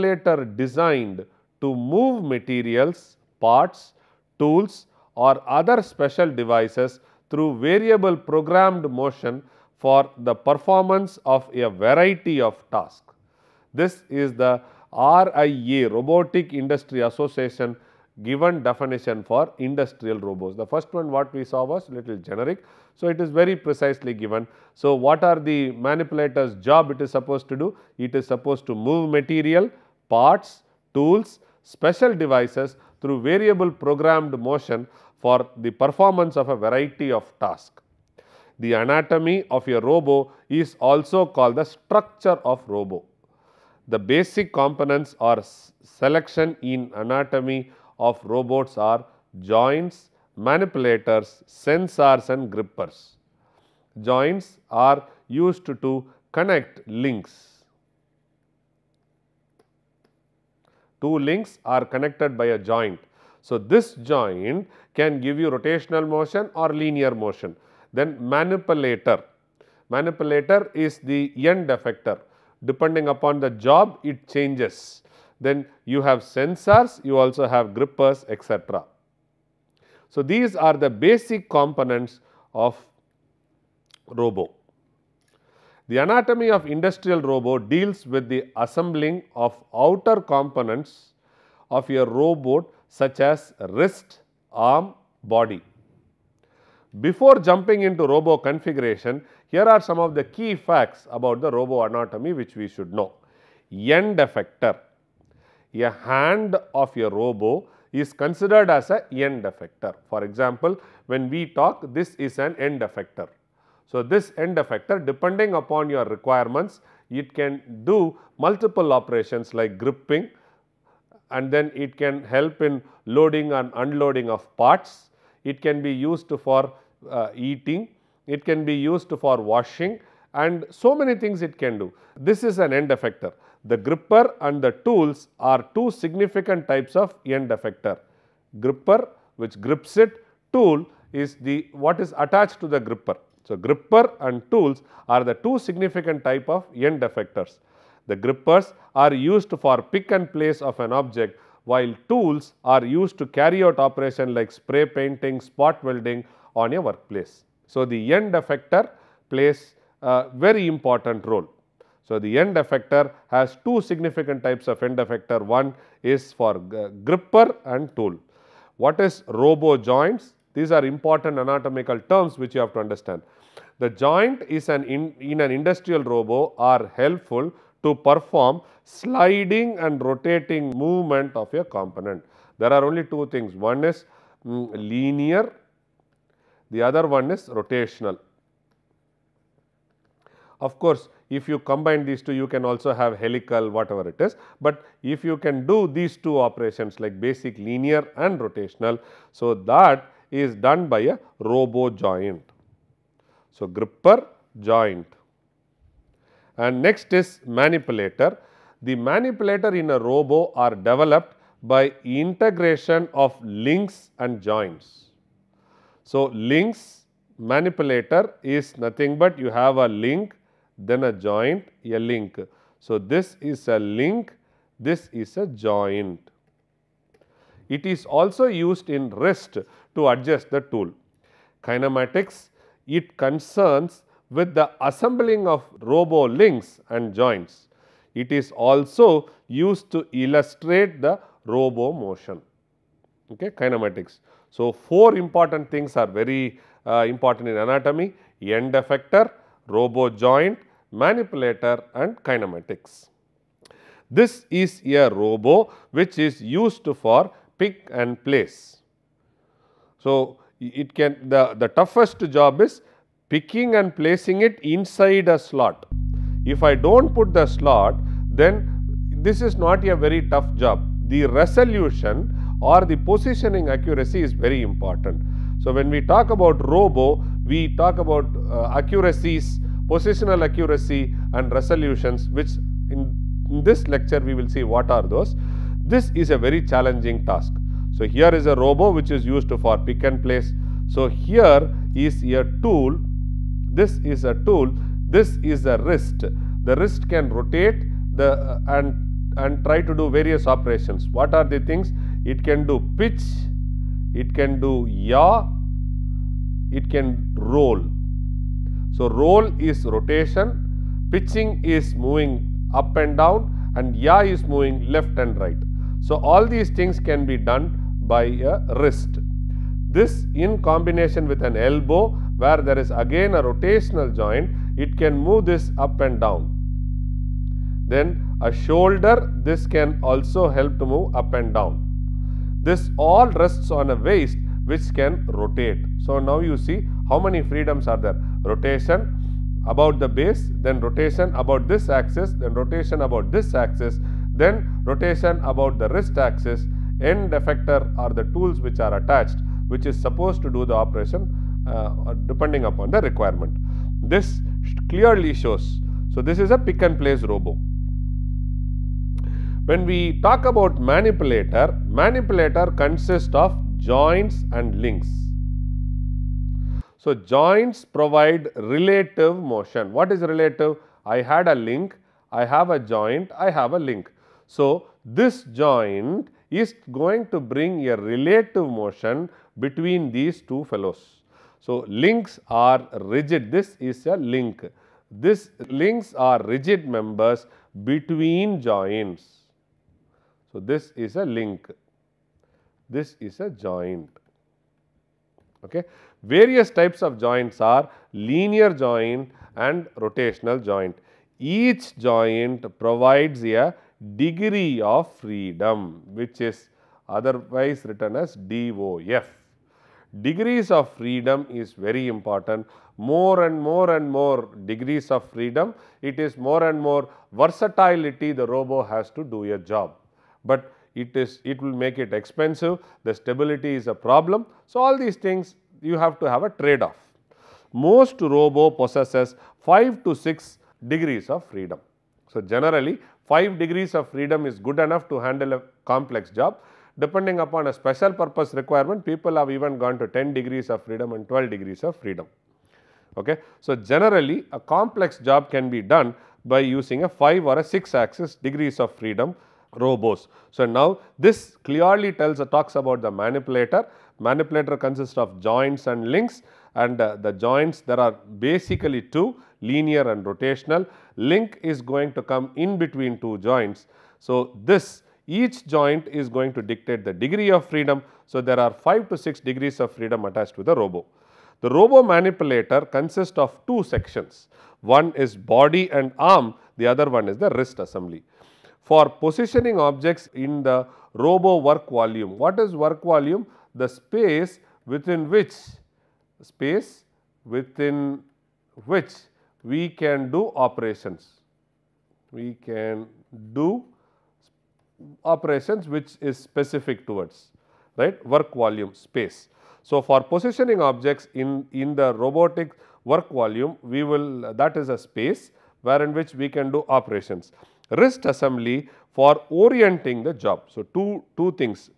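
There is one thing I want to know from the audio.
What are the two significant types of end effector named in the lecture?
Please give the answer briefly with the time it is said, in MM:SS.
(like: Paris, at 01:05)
Gripper and tools, at 02:23.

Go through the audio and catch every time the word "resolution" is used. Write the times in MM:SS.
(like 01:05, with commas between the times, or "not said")
04:31, 04:41.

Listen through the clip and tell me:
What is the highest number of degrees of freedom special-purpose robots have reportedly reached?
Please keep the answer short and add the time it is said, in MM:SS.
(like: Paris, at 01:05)
12, at 07:21.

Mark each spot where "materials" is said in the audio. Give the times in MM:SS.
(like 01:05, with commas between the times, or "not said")
00:02, 00:29.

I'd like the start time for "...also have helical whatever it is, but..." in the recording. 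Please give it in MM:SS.
03:12.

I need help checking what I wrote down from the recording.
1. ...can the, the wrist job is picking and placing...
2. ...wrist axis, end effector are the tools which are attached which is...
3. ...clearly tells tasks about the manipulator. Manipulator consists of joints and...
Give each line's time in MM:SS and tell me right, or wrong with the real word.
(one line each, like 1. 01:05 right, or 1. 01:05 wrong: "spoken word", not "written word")
1. 04:20 wrong: "toughest", not "wrist"
2. 05:45 right
3. 07:31 wrong: "talks", not "tasks".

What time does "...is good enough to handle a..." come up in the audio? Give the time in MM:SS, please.
07:14.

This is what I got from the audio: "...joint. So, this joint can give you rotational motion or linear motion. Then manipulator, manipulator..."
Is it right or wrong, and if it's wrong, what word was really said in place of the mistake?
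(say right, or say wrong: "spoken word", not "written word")
right.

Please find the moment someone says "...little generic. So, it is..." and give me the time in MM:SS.
00:21.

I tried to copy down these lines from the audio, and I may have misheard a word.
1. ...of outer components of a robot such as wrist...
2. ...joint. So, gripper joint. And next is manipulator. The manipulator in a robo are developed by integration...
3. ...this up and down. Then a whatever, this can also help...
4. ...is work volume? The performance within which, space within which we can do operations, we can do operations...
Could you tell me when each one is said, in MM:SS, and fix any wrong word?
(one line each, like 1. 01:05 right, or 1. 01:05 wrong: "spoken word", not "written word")
1. 01:29 right
2. 03:21 right
3. 05:25 wrong: "shoulder", not "whatever"
4. 08:02 wrong: "space", not "performance".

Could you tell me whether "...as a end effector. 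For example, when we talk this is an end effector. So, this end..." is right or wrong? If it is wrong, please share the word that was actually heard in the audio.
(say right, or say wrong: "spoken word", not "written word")
right.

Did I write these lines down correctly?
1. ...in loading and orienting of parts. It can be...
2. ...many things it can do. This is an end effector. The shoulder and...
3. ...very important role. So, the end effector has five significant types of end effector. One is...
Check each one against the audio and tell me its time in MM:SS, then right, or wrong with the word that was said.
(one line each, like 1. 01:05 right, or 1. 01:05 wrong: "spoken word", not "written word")
1. 02:02 wrong: "unloading", not "orienting"
2. 02:10 wrong: "gripper", not "shoulder"
3. 02:40 wrong: "two", not "five".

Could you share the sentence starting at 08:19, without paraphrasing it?
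So, for positioning objects in, in the robotic work volume we will that is a space wherein which we can do operations.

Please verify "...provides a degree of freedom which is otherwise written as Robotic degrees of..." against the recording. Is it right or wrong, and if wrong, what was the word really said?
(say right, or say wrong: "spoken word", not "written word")
wrong: "DOF", not "Robotic".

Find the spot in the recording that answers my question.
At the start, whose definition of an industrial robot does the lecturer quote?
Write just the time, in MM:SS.
00:15.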